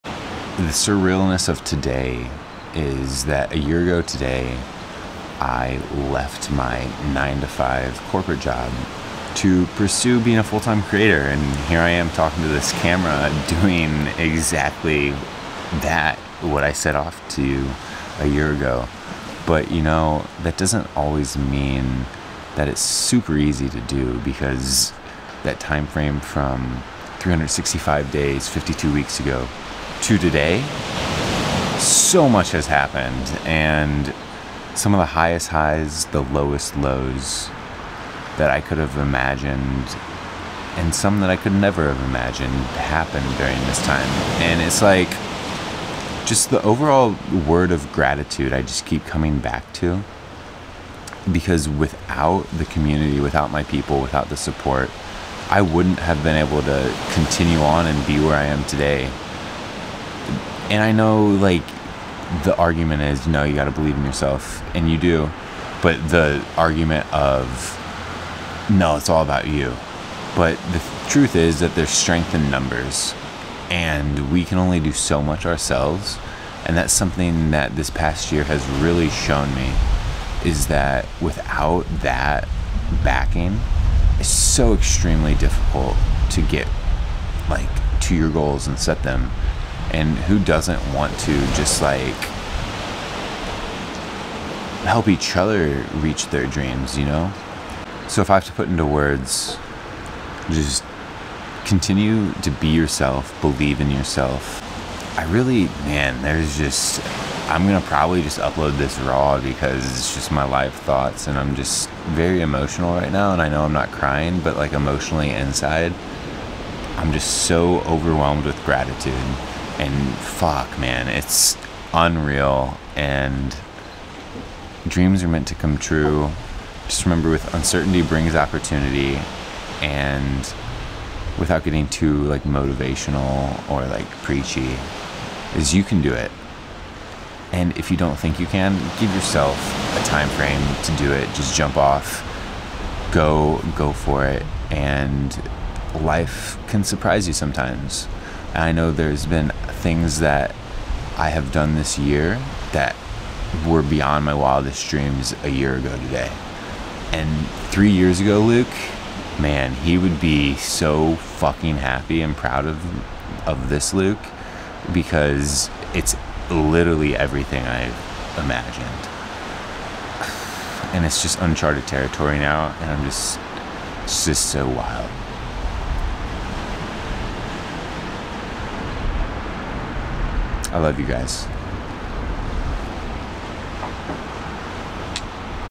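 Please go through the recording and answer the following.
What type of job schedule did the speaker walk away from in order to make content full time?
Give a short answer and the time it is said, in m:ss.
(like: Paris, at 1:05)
nine to five, at 0:07.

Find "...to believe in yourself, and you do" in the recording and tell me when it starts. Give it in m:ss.
1:03.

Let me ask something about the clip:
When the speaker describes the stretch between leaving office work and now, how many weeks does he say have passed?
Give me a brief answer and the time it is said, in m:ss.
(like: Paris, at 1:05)
52, at 0:28.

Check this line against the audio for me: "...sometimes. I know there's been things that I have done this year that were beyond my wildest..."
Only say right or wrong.
right.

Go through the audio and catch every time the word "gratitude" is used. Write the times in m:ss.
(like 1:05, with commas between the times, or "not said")
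0:47, 1:58.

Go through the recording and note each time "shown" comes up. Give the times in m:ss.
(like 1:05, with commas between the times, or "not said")
1:19.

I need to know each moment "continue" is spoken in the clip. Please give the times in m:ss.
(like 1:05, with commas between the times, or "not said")
0:57, 1:41.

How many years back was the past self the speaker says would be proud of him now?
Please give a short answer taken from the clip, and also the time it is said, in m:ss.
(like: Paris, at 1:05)
3, at 2:37.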